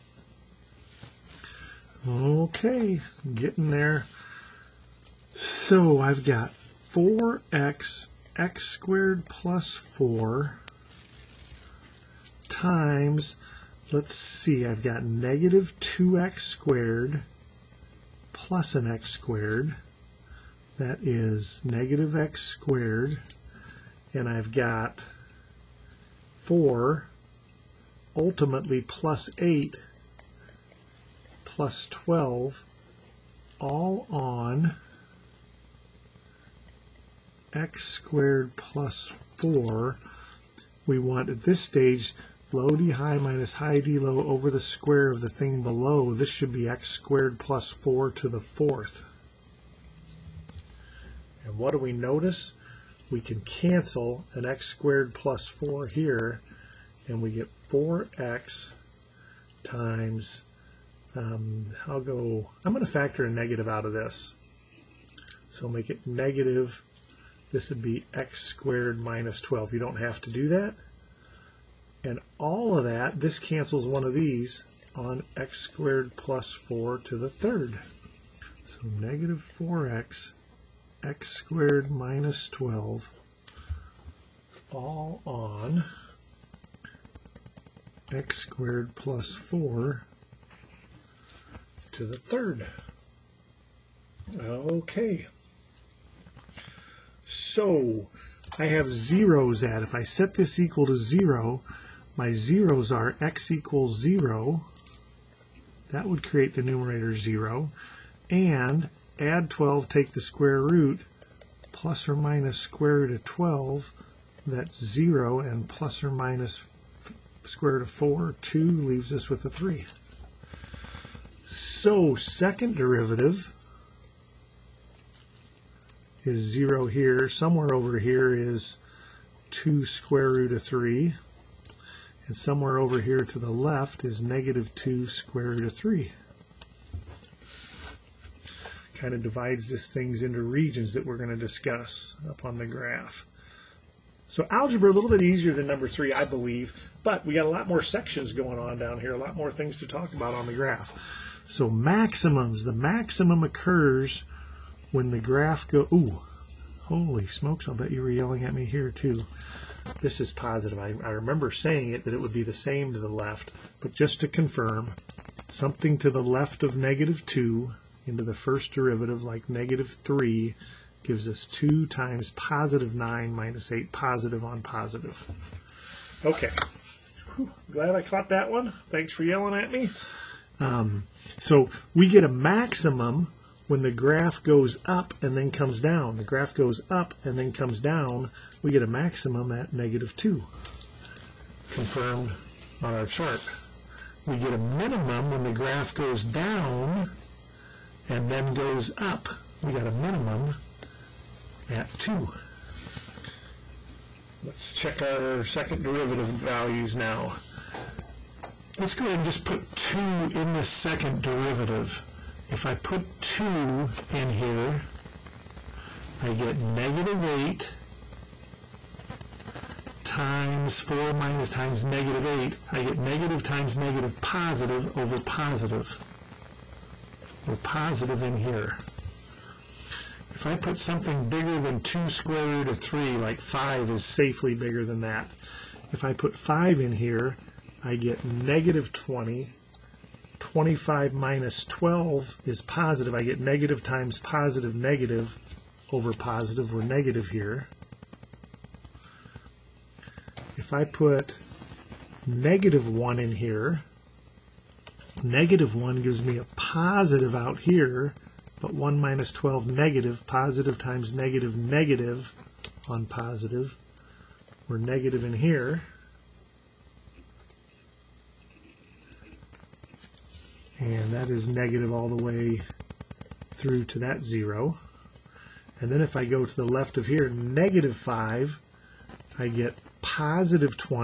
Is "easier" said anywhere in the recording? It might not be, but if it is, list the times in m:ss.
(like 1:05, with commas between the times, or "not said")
2:25.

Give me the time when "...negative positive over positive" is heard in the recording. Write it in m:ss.
3:43.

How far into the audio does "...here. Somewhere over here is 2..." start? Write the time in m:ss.
2:06.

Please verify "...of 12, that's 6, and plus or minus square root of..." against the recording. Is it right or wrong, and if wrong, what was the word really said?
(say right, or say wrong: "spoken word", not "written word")
wrong: "0", not "6".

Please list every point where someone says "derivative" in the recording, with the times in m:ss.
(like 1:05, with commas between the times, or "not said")
2:02, 2:48, 3:25, 3:31.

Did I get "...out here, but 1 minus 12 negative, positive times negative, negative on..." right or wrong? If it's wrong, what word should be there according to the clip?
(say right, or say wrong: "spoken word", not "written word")
right.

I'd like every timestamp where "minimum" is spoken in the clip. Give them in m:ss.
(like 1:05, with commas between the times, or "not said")
3:14, 3:19.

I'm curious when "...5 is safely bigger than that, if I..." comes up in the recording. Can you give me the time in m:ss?
3:53.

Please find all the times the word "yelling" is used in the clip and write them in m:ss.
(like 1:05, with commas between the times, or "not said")
2:38, 2:59.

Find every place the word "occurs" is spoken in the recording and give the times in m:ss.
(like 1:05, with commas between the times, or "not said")
2:33.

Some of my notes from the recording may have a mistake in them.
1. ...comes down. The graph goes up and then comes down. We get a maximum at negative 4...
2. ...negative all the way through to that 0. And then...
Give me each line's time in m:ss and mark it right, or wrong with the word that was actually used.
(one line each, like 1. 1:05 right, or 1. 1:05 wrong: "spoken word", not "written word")
1. 3:05 wrong: "2", not "4"
2. 4:31 right.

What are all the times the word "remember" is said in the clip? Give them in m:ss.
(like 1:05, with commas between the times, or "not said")
2:41.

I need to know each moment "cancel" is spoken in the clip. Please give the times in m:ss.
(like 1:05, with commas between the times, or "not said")
0:53, 1:13.